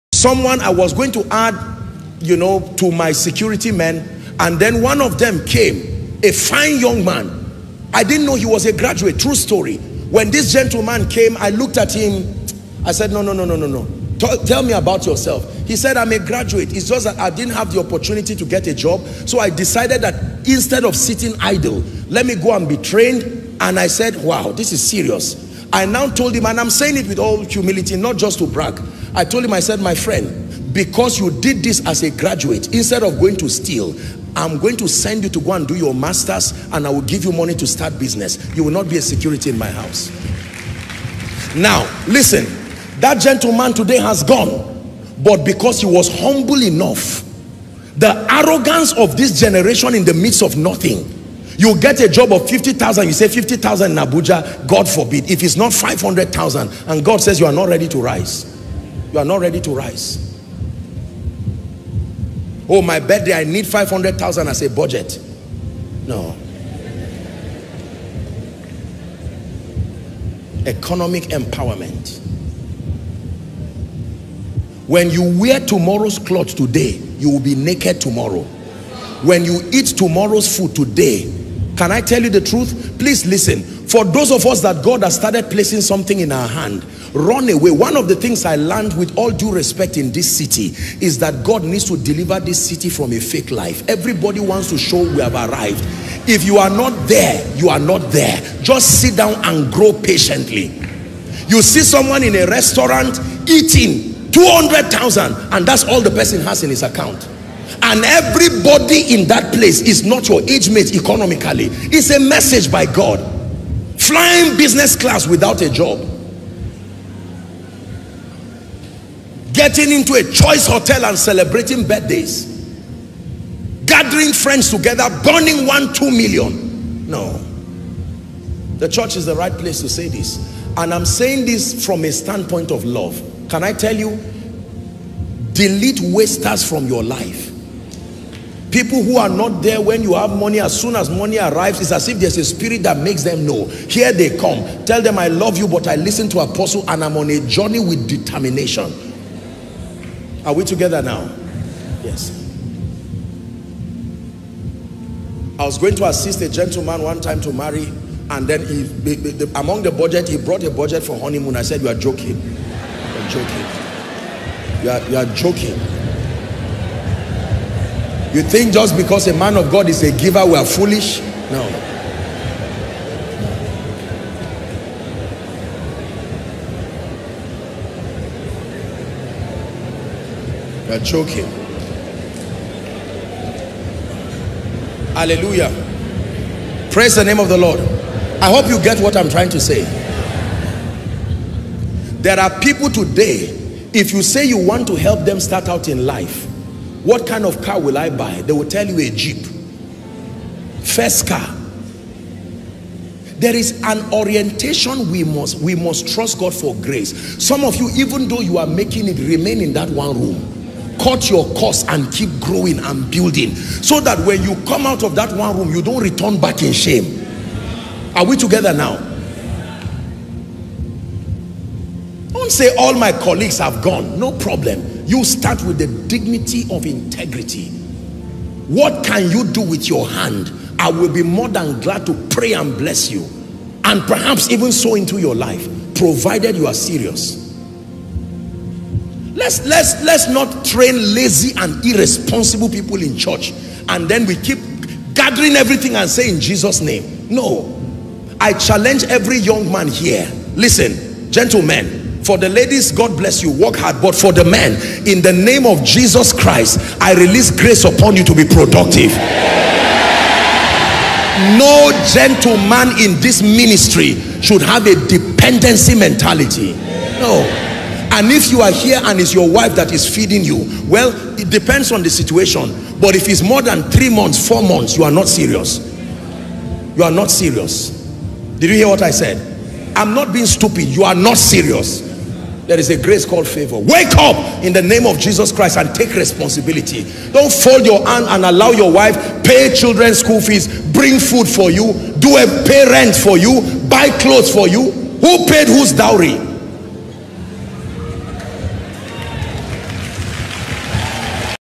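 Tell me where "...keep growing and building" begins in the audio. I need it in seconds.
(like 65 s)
212 s.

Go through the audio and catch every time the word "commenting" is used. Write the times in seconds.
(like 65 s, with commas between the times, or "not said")
not said.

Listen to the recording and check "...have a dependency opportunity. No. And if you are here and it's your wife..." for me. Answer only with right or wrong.
wrong.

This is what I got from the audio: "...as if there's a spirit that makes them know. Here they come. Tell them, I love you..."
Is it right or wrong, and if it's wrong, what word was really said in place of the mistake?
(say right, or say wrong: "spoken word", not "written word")
right.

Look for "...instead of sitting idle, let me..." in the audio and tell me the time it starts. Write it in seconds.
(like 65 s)
20 s.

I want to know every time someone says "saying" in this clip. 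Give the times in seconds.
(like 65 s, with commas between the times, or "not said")
26 s, 131 s.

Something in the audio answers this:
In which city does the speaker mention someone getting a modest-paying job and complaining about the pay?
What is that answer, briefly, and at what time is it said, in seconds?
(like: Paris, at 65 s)
Abuja, at 54 s.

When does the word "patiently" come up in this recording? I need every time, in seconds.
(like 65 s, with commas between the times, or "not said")
99 s.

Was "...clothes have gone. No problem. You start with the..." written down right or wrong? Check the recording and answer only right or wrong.
wrong.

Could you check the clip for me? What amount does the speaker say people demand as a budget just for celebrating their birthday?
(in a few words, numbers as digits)
500,000.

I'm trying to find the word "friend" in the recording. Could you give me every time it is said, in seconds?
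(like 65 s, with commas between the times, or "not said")
29 s, 124 s.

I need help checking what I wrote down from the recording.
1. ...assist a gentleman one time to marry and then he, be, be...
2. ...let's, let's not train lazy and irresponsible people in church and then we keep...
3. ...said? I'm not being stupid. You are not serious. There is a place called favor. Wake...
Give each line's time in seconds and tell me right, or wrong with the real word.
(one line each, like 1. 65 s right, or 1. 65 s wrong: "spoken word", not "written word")
1. 156 s right
2. 239 s right
3. 279 s wrong: "grace", not "place".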